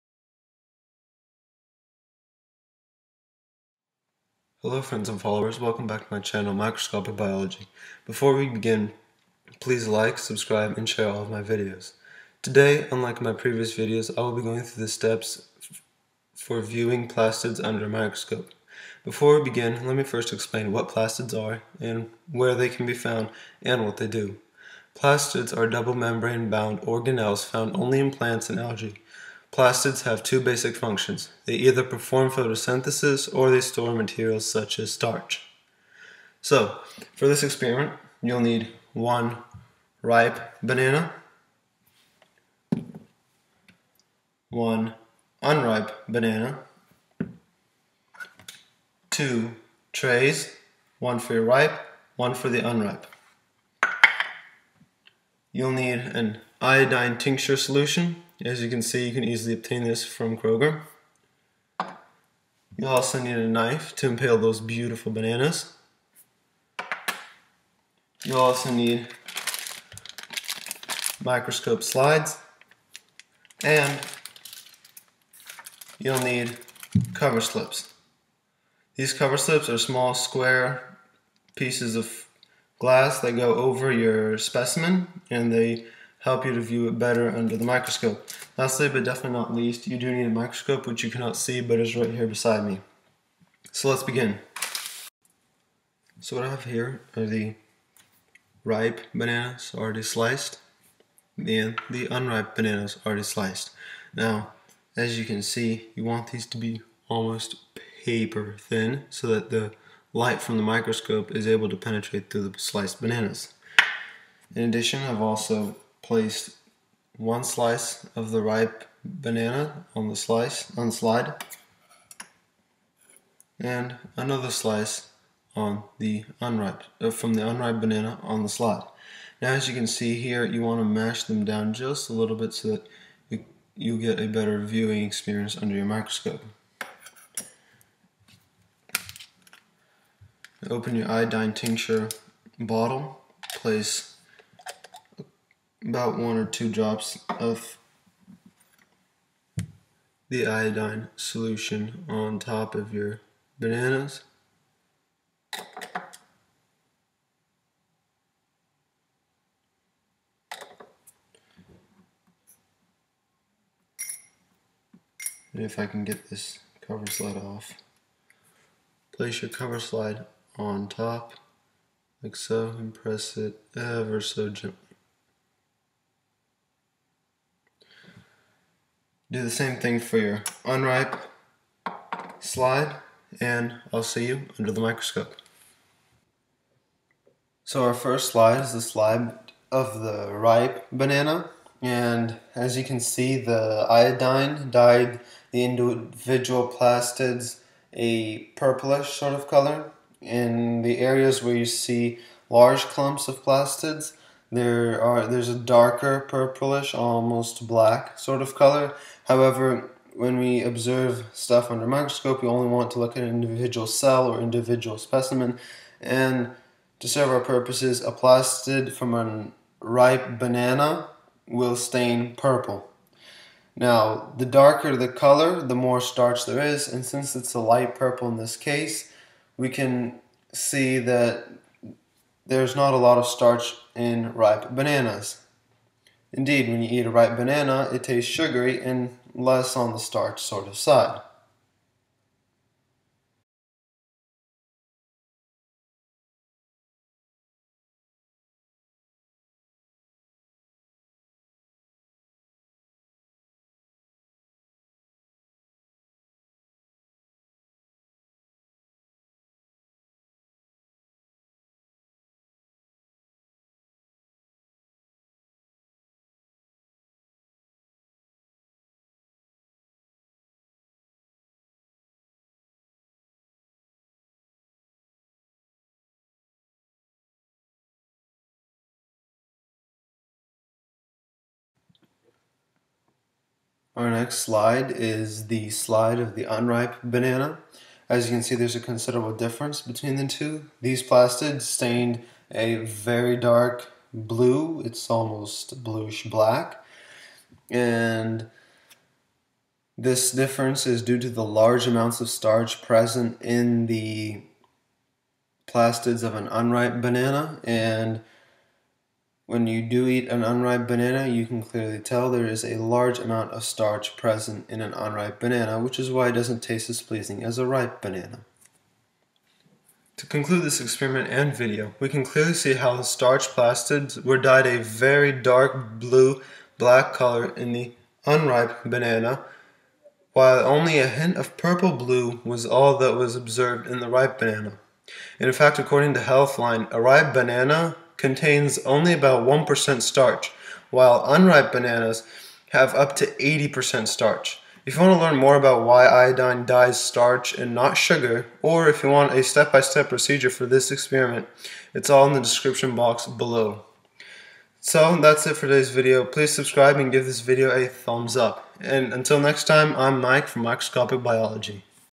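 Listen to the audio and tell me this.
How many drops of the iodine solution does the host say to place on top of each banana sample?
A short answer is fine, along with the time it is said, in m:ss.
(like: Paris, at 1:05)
1 or 2, at 2:26.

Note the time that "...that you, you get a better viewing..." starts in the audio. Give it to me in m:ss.
2:12.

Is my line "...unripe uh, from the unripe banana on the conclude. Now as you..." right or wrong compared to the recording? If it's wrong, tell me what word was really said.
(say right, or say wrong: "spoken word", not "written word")
wrong: "slide", not "conclude".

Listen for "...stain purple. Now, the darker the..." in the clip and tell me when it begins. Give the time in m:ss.
3:41.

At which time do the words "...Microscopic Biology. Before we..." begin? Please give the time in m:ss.
0:06.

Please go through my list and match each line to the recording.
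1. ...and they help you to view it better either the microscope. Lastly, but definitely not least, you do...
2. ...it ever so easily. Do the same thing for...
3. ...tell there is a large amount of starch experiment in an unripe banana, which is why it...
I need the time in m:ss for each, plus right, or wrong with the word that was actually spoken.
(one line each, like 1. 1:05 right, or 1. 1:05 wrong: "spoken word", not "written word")
1. 1:25 wrong: "under", not "either"
2. 2:53 wrong: "gently", not "easily"
3. 5:11 wrong: "present", not "experiment".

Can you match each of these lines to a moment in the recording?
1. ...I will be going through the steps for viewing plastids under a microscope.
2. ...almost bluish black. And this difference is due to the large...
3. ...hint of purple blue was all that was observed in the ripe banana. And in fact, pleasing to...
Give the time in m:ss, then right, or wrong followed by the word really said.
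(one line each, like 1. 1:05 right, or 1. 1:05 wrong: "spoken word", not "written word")
1. 0:14 right
2. 4:55 right
3. 5:31 wrong: "according", not "pleasing".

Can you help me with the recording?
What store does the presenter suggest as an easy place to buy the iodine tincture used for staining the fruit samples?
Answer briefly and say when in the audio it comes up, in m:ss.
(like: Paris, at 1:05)
Kroger, at 1:00.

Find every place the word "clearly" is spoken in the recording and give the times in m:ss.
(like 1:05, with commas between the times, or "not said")
5:11, 5:22.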